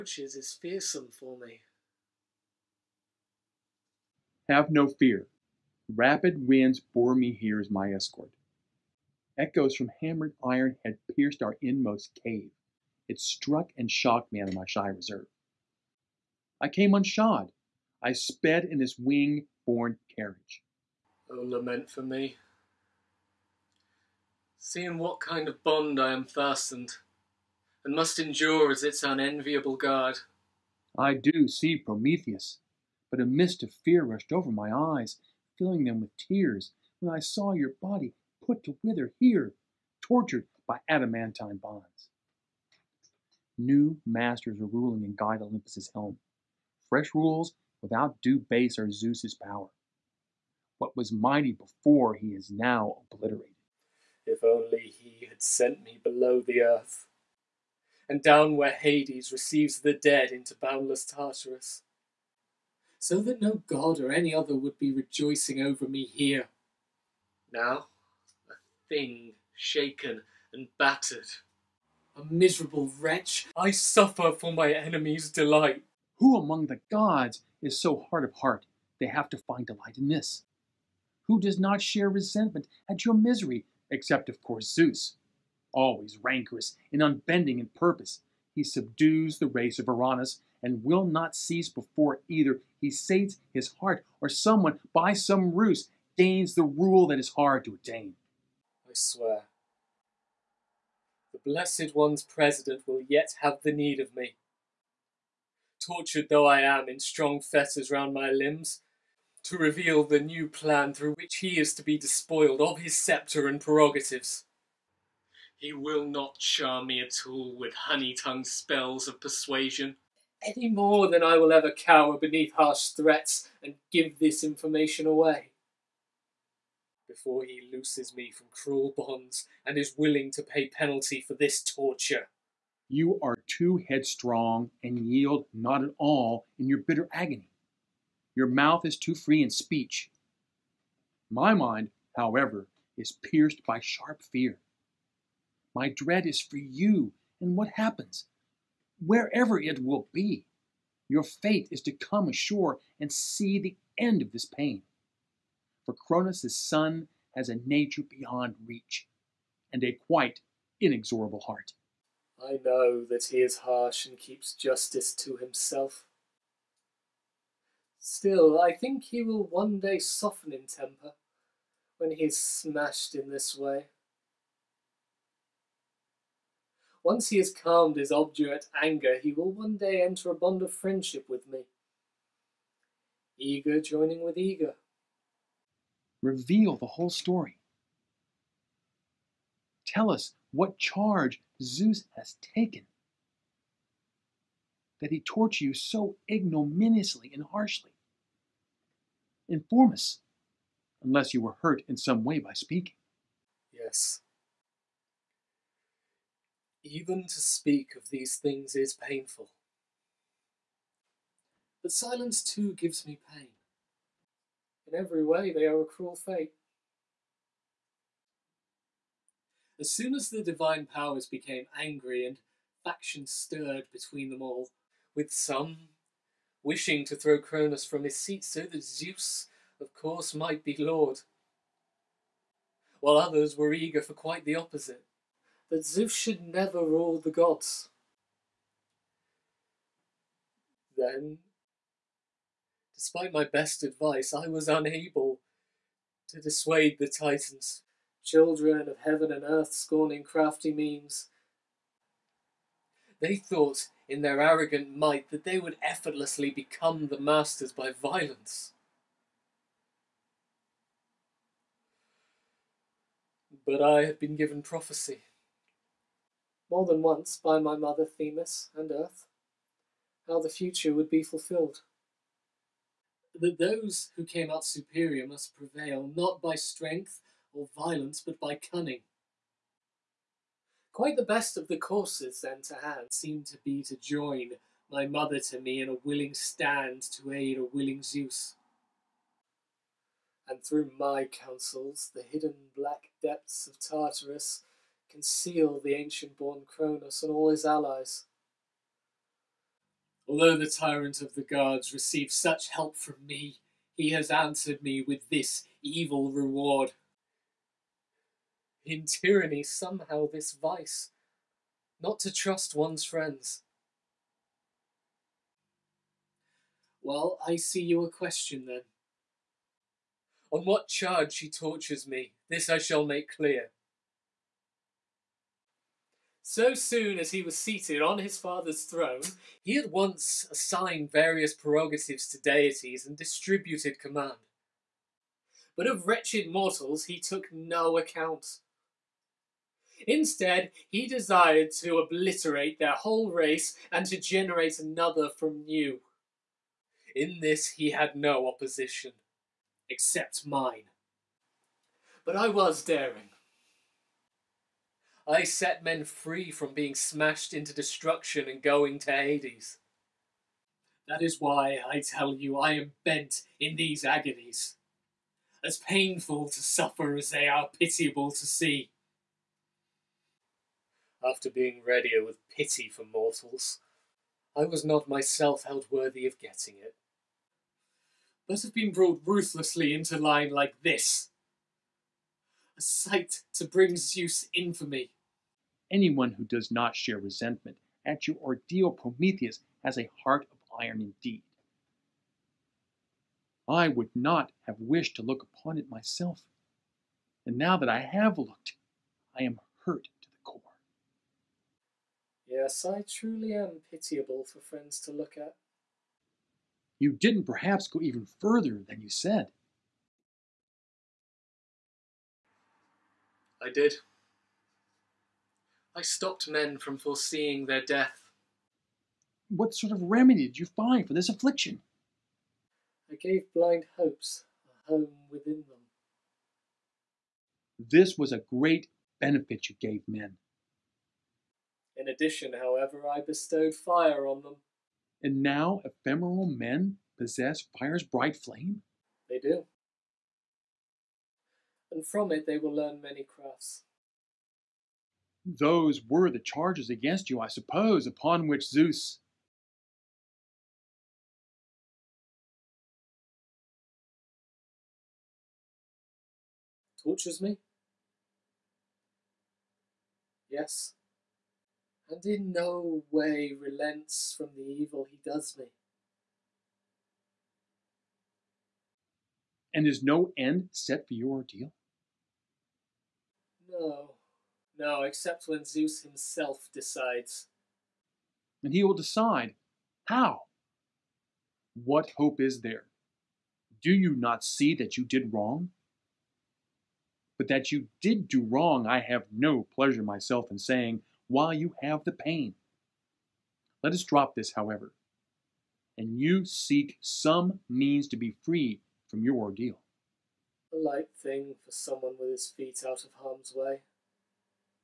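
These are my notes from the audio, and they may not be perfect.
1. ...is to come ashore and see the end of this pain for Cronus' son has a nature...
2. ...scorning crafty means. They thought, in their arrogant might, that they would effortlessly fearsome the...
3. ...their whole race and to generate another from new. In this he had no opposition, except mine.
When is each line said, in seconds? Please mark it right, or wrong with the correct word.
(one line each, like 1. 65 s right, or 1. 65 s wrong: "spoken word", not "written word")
1. 151 s right
2. 249 s wrong: "become", not "fearsome"
3. 342 s right.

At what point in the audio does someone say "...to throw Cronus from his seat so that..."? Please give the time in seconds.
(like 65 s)
227 s.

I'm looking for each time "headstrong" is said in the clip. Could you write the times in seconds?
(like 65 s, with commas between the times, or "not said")
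133 s.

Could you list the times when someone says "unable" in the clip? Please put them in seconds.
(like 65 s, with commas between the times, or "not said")
244 s.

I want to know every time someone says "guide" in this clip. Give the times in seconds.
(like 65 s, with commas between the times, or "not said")
45 s.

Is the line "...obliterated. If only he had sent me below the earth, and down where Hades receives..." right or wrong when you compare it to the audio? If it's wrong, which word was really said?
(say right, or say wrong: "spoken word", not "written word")
right.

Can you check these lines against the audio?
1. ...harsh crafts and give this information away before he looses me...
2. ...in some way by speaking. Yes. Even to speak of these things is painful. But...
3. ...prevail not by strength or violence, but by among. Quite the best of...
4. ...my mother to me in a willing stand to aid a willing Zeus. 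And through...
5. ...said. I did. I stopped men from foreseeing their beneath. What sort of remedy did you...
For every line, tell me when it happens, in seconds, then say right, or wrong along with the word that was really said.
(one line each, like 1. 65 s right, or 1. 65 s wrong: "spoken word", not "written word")
1. 122 s wrong: "threats", not "crafts"
2. 201 s right
3. 275 s wrong: "cunning", not "among"
4. 284 s right
5. 409 s wrong: "death", not "beneath".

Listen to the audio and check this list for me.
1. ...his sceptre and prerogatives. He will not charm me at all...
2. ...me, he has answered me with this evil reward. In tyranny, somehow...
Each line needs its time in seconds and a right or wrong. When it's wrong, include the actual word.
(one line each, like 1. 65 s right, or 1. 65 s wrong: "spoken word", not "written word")
1. 112 s right
2. 303 s right.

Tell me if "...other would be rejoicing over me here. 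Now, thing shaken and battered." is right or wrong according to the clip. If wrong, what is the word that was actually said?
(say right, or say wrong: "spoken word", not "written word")
right.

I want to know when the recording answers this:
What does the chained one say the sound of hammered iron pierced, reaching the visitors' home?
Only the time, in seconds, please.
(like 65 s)
11 s.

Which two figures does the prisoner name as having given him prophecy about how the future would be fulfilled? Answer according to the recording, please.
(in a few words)
Themis and Earth.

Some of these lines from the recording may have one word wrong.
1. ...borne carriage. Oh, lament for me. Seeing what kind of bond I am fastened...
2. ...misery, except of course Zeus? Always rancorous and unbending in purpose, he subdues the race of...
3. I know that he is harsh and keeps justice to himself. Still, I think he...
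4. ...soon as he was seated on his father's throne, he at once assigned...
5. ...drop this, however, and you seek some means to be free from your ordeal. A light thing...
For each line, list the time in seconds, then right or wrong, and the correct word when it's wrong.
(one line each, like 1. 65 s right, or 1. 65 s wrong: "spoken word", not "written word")
1. 19 s right
2. 83 s right
3. 162 s right
4. 326 s right
5. 494 s right.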